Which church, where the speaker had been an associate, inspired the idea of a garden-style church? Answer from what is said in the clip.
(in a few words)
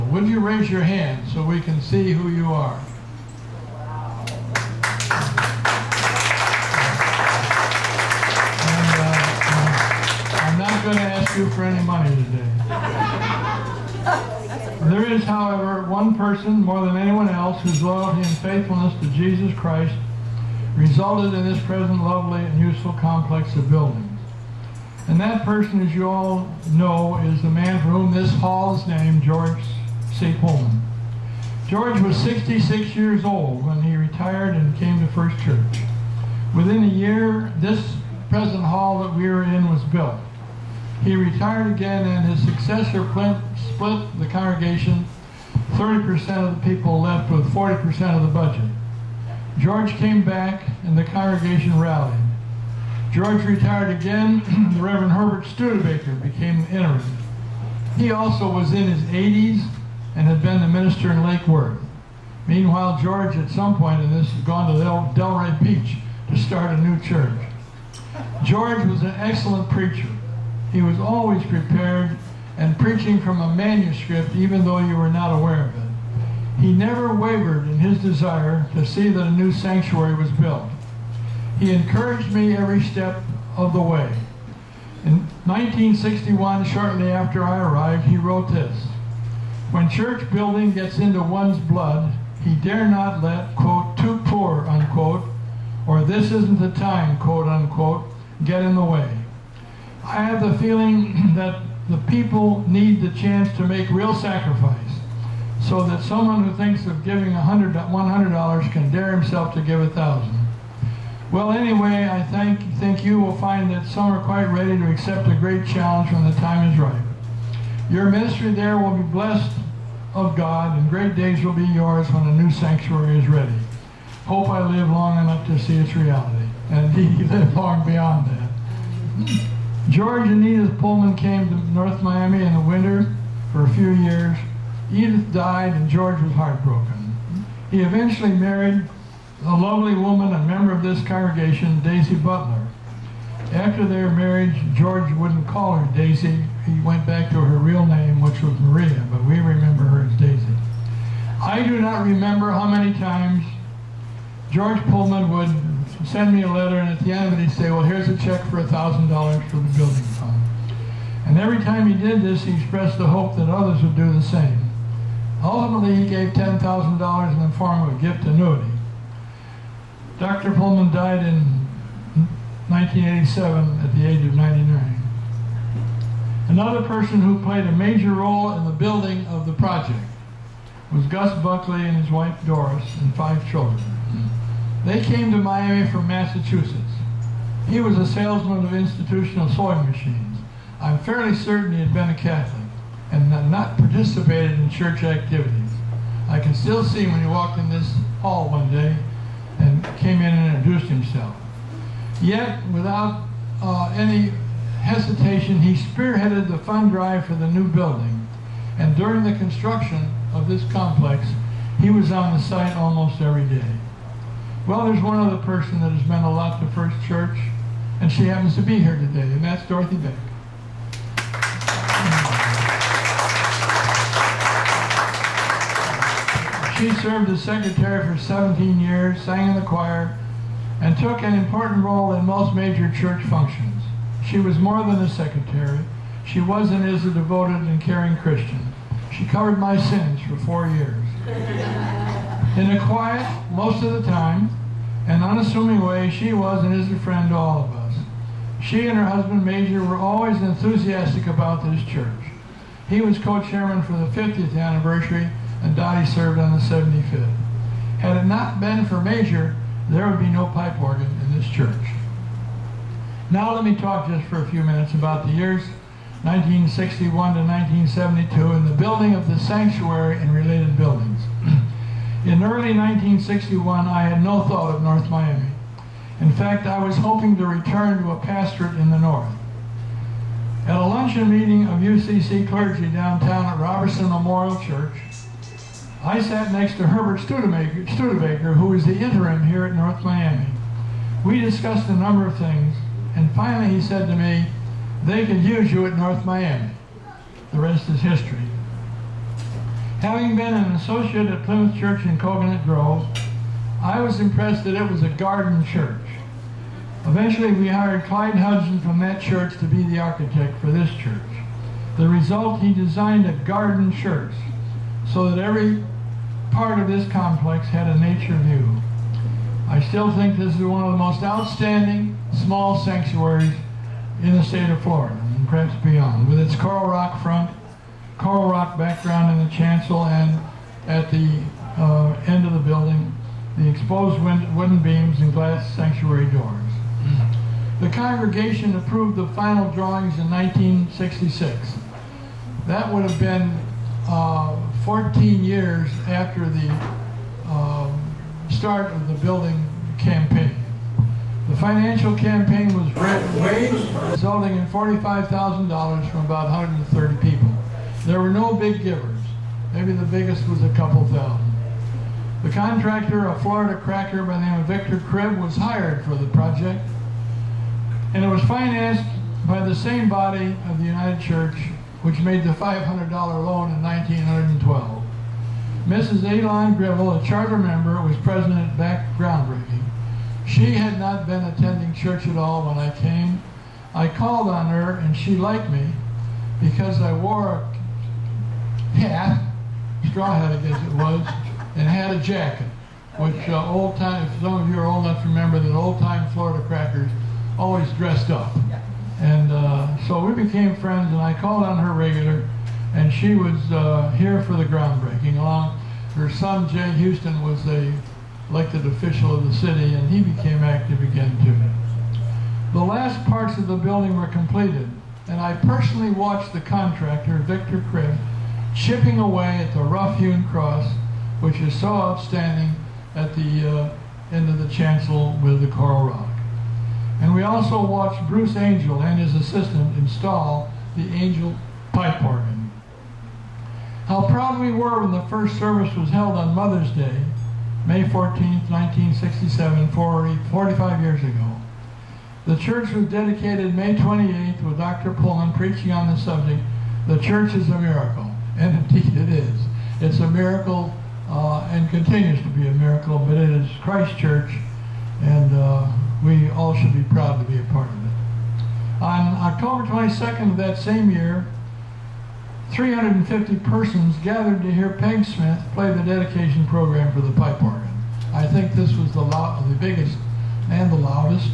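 Plymouth Church.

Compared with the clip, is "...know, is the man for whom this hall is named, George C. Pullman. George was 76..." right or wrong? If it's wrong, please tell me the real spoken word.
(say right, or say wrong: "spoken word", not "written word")
wrong: "66", not "76".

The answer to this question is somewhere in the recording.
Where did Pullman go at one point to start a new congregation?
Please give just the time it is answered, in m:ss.
1:04.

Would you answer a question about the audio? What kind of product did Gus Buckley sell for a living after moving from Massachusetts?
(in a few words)
institutional sewing machines.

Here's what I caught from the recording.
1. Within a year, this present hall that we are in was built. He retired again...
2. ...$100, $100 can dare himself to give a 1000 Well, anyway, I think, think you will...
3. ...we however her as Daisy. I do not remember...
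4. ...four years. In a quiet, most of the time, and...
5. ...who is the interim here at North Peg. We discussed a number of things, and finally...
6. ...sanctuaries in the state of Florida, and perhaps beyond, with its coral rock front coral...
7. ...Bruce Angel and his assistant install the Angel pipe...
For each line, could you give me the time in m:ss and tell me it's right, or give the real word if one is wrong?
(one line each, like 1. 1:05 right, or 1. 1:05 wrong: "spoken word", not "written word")
1. 0:36 right
2. 1:47 right
3. 2:29 wrong: "remember", not "however"
4. 4:00 right
5. 4:48 wrong: "Miami", not "Peg"
6. 5:22 right
7. 7:08 right.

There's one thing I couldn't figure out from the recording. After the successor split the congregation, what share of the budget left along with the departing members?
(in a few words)
40%.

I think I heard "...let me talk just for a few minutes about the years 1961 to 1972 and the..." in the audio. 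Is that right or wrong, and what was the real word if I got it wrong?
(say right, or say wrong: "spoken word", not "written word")
right.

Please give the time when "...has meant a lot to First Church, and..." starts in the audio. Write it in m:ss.
3:35.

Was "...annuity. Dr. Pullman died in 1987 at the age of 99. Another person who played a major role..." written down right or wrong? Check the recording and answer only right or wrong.
right.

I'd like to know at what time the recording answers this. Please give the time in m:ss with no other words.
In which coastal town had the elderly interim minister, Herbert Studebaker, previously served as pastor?
1:01.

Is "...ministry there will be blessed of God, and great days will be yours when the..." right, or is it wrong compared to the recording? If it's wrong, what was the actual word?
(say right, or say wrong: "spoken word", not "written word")
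right.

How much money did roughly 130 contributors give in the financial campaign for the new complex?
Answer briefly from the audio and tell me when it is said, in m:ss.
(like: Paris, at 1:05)
$45,000, at 5:54.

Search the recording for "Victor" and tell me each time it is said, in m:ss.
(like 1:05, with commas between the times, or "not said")
6:04, 6:57.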